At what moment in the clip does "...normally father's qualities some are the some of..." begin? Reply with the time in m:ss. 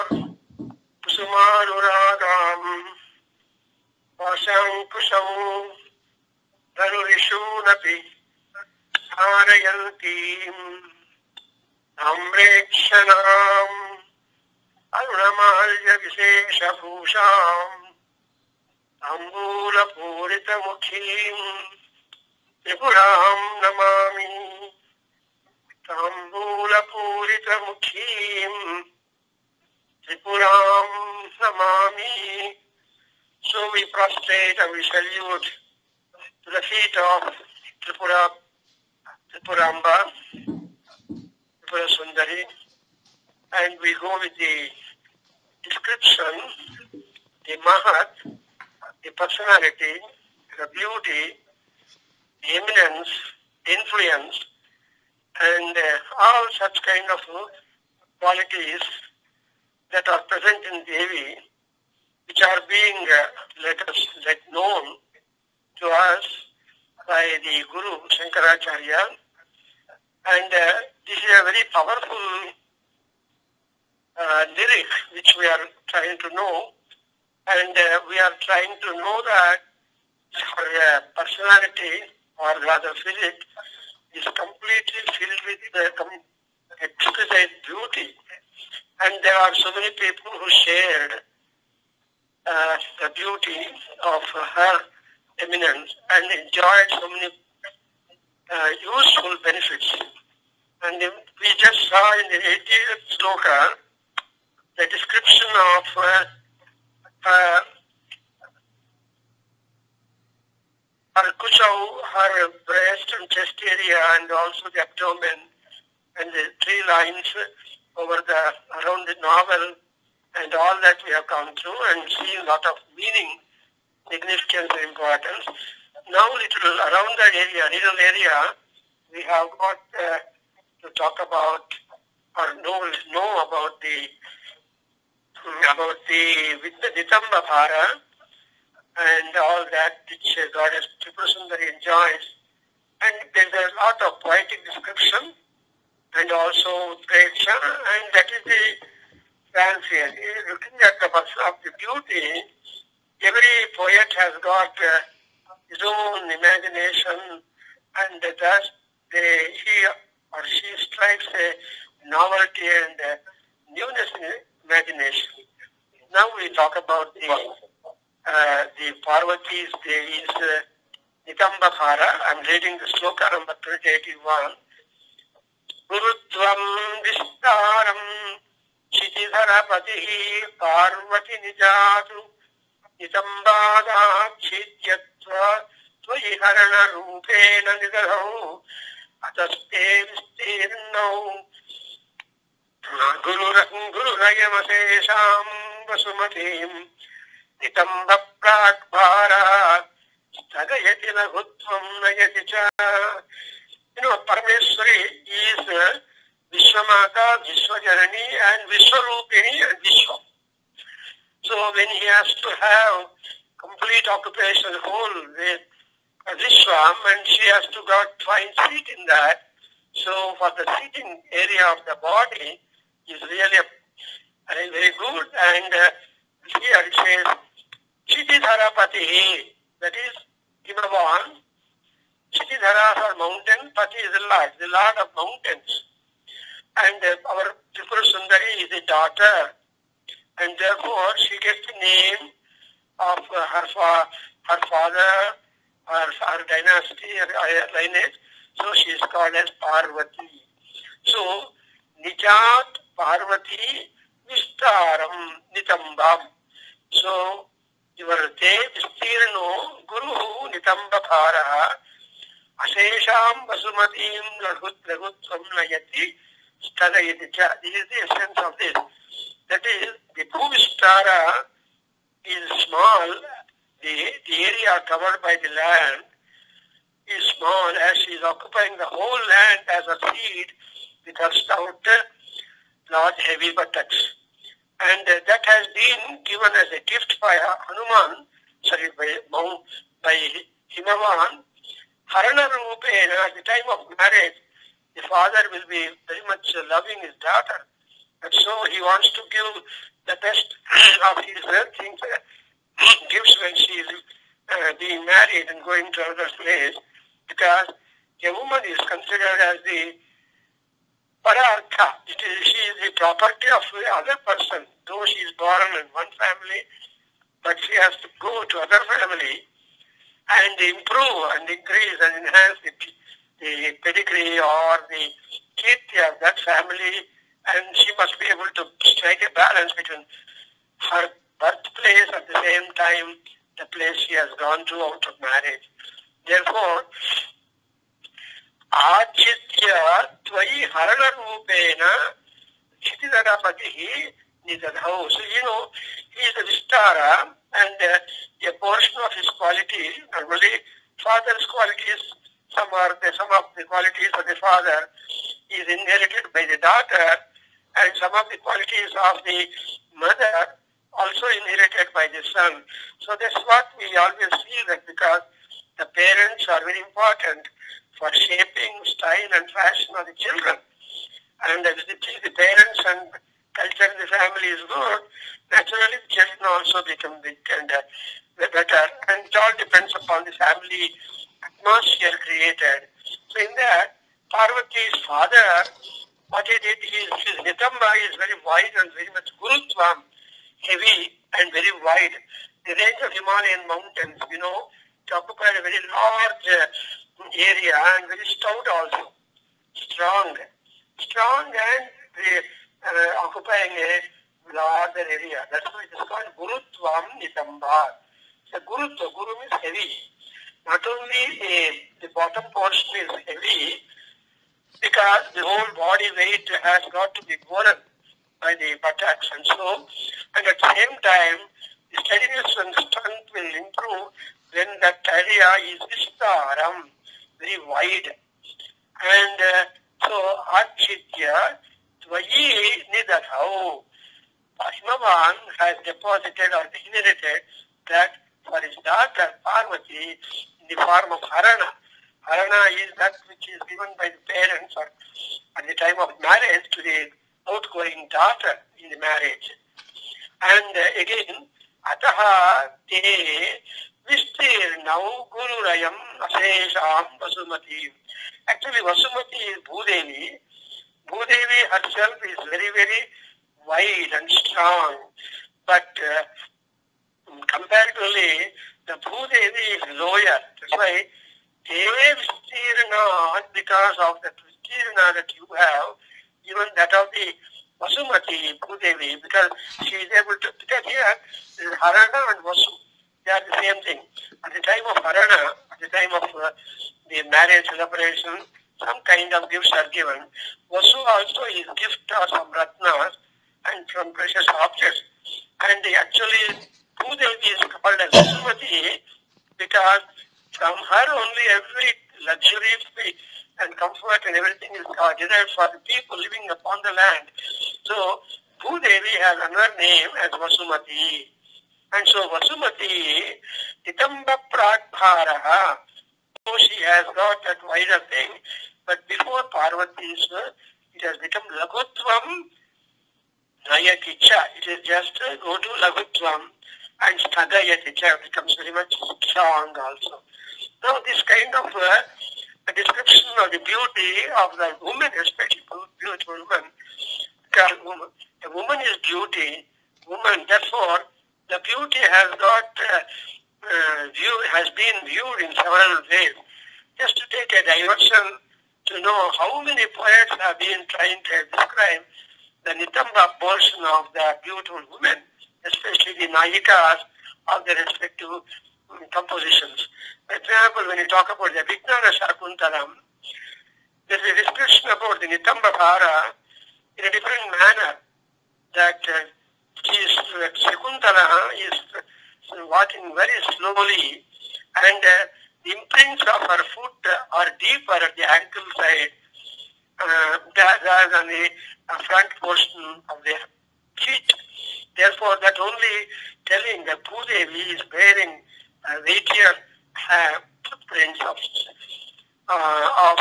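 5:50.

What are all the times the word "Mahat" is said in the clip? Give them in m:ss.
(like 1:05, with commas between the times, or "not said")
0:47.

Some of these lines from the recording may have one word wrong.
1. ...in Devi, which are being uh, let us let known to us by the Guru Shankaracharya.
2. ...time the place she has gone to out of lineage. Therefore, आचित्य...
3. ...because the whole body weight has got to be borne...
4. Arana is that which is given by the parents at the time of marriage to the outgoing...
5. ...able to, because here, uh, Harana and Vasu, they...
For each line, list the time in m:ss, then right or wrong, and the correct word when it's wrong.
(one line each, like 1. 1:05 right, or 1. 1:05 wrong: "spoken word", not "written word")
1. 1:00 right
2. 5:32 wrong: "marriage", not "lineage"
3. 6:54 right
4. 7:22 right
5. 8:00 right.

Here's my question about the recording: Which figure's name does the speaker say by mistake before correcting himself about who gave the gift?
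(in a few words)
Hanuman.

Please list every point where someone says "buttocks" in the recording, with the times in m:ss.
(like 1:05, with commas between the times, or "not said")
4:43, 6:58.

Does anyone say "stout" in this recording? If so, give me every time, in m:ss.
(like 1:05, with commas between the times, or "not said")
4:41, 6:38.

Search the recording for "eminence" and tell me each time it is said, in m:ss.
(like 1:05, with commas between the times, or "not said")
0:52, 1:35.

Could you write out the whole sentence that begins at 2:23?
And there is a lot of poetic description and also pressure and that is the fancy.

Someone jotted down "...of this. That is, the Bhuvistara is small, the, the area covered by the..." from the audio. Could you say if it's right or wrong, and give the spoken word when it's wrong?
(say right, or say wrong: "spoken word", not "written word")
right.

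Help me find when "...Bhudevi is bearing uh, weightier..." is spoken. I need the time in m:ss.
9:47.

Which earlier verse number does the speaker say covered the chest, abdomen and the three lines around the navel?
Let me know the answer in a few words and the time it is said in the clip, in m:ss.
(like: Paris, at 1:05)
80, at 1:42.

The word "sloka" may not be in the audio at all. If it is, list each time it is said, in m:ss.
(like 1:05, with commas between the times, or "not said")
1:43, 2:52.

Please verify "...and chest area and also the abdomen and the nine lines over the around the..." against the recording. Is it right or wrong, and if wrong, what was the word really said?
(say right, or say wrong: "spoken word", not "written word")
wrong: "three", not "nine".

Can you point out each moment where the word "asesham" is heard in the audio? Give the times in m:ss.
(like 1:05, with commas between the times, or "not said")
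4:22, 7:36.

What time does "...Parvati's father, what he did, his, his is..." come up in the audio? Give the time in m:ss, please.
6:24.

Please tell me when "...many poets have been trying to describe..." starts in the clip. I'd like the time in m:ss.
9:09.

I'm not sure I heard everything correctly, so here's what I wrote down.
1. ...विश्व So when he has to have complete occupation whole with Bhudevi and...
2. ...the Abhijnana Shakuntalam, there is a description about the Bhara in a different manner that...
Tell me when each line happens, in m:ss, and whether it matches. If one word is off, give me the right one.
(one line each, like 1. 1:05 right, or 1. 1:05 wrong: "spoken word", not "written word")
1. 3:29 wrong: "Islam", not "Bhudevi"
2. 9:21 wrong: "Nitambabhara", not "Bhara".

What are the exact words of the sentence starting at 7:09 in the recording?
And uh, so Architya Tvayi Nidadhau.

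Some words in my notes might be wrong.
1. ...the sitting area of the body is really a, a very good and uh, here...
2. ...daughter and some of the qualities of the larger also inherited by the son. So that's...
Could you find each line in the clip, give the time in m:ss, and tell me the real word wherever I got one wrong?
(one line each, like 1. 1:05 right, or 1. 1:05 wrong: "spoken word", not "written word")
1. 3:40 right
2. 5:56 wrong: "mother", not "larger".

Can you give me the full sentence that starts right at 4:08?
So she is called as Parvati.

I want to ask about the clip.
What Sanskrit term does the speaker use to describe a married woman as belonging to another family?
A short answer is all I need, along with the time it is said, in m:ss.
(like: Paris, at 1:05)
parartha, at 5:11.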